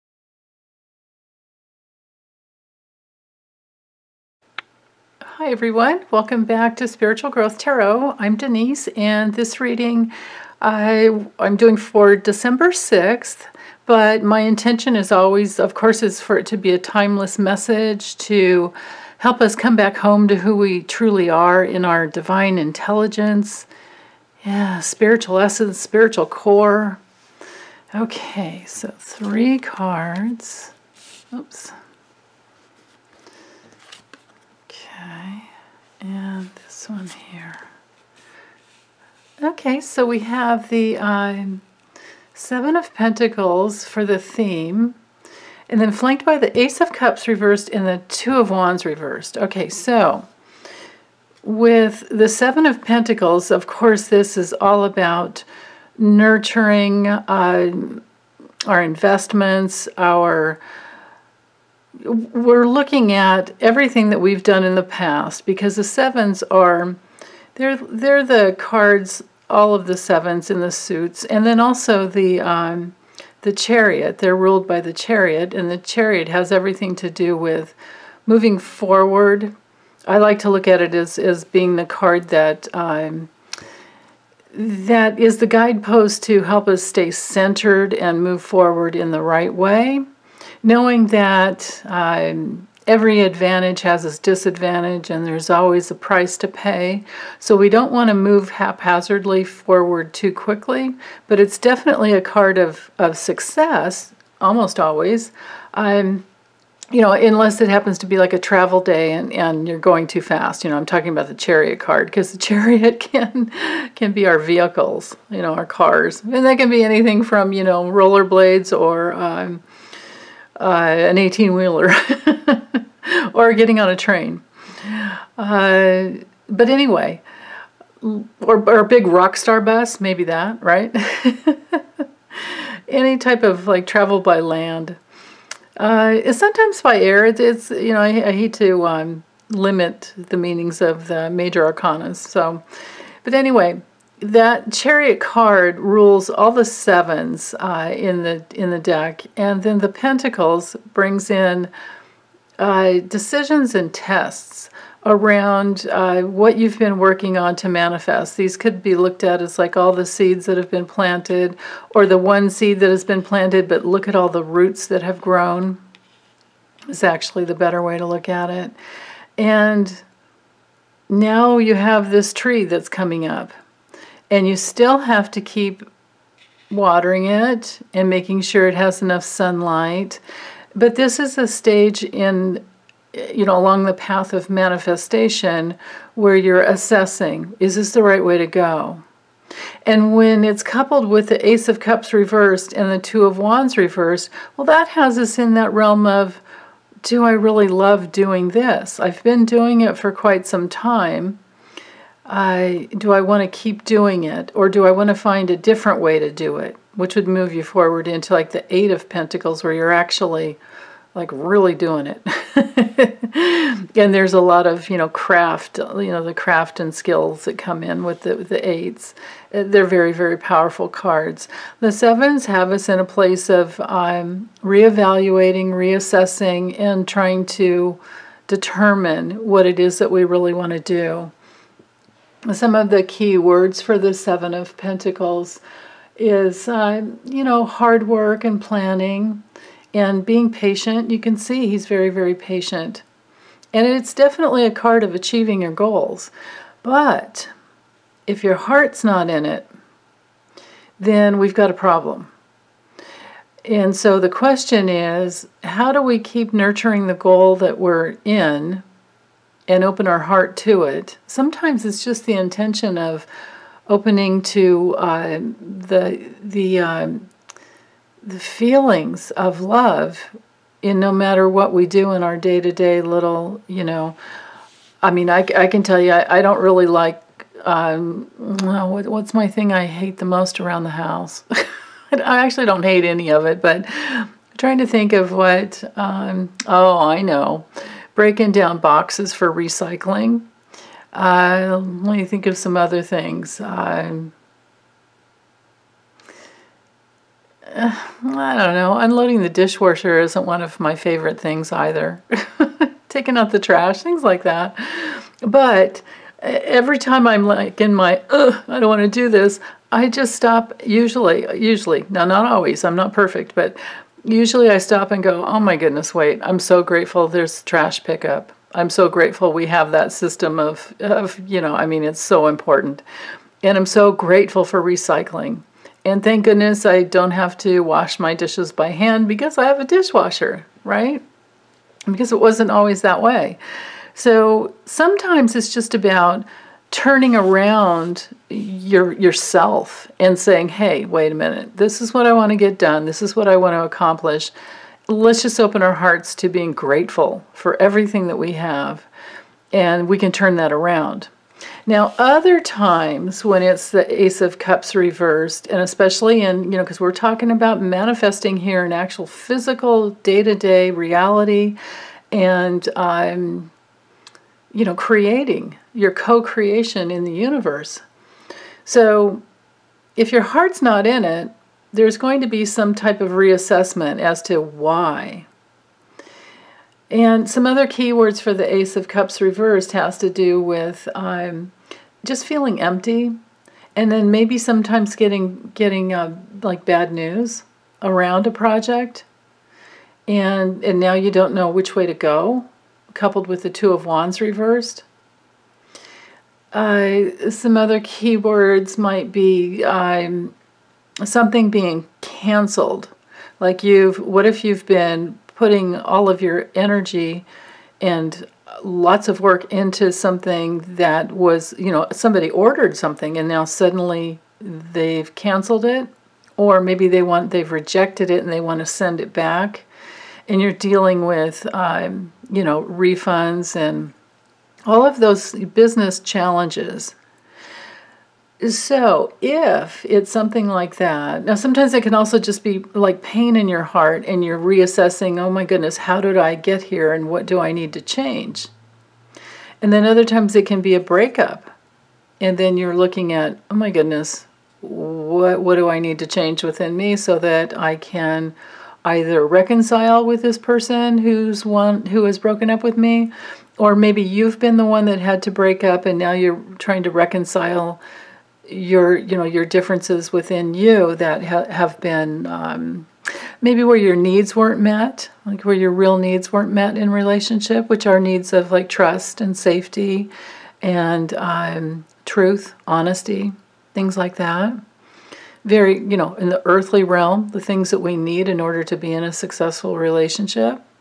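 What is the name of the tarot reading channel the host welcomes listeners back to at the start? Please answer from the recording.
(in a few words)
Spiritual Growth Tarot.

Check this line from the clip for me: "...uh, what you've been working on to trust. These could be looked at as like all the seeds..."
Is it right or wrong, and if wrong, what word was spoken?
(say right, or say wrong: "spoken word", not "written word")
wrong: "manifest", not "trust".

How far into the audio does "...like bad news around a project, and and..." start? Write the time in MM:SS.
06:26.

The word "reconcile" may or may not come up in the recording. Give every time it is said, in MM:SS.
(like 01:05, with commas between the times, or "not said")
07:29, 07:37.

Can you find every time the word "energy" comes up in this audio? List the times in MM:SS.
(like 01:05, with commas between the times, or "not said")
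06:46.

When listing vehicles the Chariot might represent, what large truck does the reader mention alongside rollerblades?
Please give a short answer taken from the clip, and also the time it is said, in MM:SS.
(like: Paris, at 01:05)
18 wheeler, at 02:00.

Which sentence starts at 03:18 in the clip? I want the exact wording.
I've been doing it for quite some time.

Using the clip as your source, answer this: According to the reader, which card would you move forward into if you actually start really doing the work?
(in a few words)
8 of Pentacles.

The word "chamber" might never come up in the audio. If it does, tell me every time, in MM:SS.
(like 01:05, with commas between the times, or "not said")
not said.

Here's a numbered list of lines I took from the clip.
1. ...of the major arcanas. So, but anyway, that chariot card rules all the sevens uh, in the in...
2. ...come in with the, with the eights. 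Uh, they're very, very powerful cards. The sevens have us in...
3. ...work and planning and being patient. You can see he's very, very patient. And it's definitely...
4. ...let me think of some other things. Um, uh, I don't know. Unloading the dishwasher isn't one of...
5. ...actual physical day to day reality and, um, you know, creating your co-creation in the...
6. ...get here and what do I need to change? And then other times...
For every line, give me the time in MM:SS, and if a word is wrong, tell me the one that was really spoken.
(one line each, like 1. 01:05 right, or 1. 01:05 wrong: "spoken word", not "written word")
1. 02:20 right
2. 03:37 right
3. 03:58 right
4. 04:51 right
5. 05:58 right
6. 07:16 right.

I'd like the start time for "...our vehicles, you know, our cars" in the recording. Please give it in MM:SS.
01:54.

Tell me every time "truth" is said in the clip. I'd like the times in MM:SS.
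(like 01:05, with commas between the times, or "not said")
07:52.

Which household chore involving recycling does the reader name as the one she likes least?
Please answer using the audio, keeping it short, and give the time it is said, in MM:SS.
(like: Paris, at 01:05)
Breaking down boxes, at 04:48.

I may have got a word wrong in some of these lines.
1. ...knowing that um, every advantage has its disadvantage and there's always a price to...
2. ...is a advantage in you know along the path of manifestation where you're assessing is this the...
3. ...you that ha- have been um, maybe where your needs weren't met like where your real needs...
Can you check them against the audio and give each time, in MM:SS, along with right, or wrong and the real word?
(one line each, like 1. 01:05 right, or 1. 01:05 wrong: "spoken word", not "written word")
1. 01:30 right
2. 03:01 wrong: "stage", not "advantage"
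3. 07:40 right.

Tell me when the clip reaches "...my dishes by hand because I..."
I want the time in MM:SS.
05:28.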